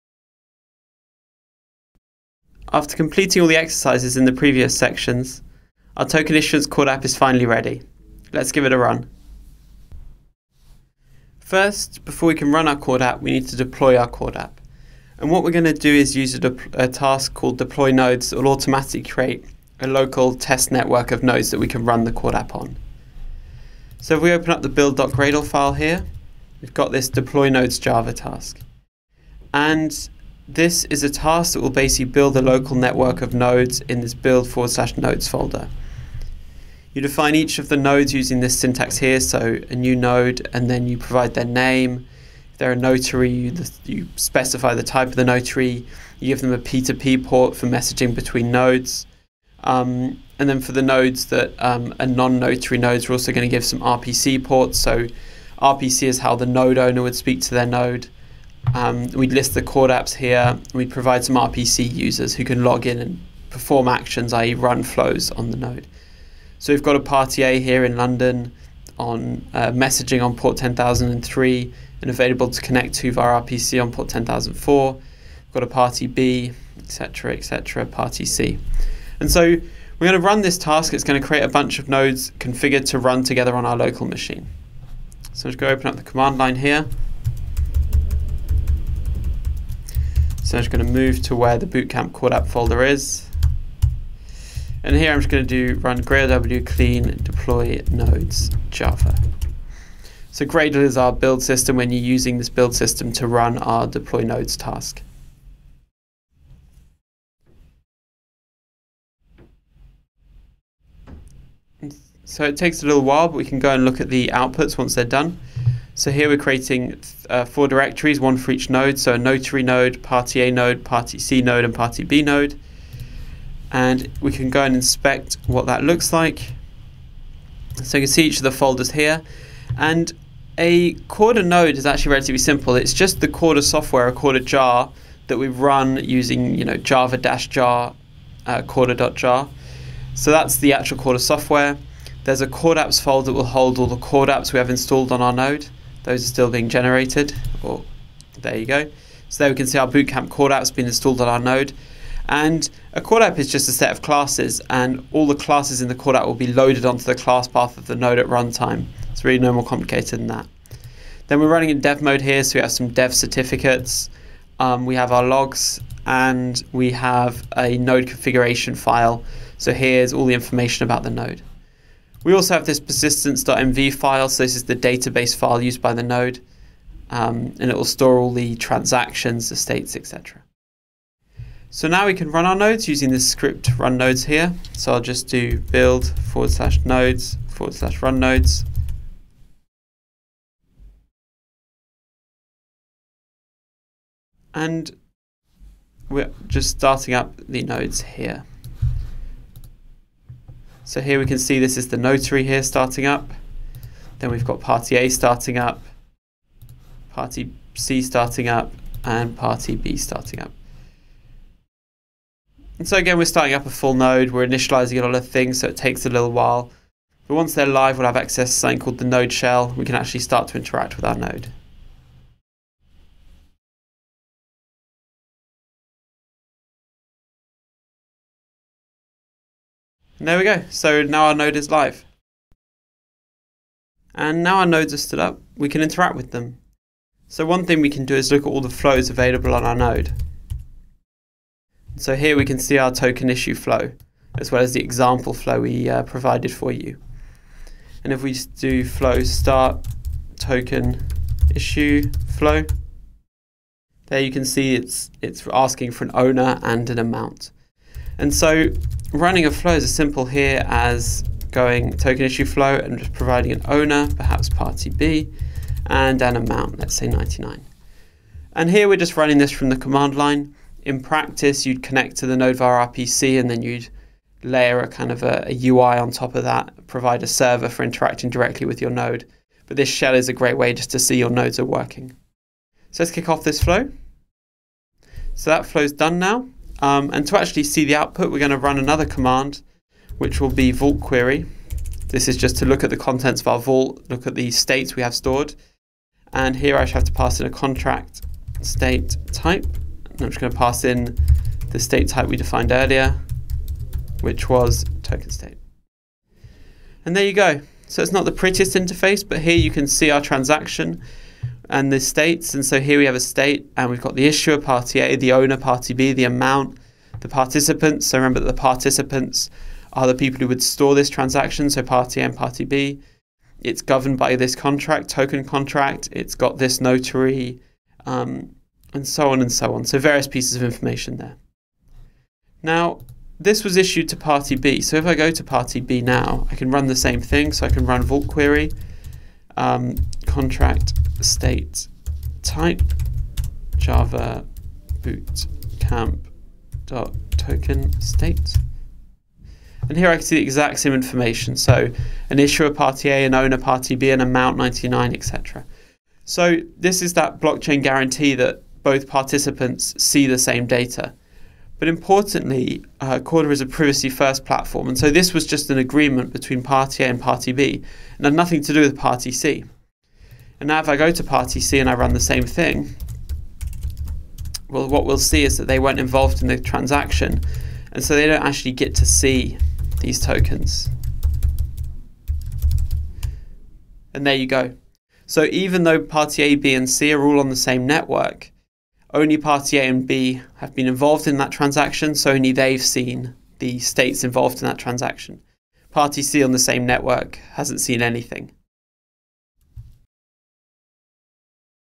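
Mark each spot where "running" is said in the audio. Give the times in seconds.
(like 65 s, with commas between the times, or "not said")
161 s, 259 s, 269 s.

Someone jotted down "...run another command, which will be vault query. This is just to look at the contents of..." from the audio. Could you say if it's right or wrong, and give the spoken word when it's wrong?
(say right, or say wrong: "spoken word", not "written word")
right.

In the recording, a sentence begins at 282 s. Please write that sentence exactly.
So let's kick off this flow.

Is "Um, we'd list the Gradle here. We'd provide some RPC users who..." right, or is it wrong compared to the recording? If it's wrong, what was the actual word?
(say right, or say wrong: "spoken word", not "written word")
wrong: "CorDapps", not "Gradle".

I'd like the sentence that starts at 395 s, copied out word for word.
Party C on the same network hasn't seen anything.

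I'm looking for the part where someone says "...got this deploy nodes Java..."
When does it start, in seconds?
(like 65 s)
26 s.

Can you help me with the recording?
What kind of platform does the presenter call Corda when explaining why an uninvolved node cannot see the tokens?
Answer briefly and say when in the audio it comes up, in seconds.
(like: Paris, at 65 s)
privacy first, at 363 s.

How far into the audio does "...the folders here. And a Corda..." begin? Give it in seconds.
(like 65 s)
128 s.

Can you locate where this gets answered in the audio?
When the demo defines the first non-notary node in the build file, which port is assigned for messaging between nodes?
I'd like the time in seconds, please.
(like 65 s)
70 s.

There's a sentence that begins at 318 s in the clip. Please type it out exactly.
So remember that the participants are the people who would store this transaction, so party A and party B.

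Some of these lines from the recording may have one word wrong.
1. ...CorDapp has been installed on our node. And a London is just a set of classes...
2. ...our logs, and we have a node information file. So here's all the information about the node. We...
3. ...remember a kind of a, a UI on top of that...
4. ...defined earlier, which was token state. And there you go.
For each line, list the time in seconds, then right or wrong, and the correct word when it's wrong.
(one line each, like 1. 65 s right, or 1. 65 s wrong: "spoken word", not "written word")
1. 150 s wrong: "CorDapp", not "London"
2. 165 s wrong: "configuration", not "information"
3. 274 s wrong: "layer", not "remember"
4. 302 s right.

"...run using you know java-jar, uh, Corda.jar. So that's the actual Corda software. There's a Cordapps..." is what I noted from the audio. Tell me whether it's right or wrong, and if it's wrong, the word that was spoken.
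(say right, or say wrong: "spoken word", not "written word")
right.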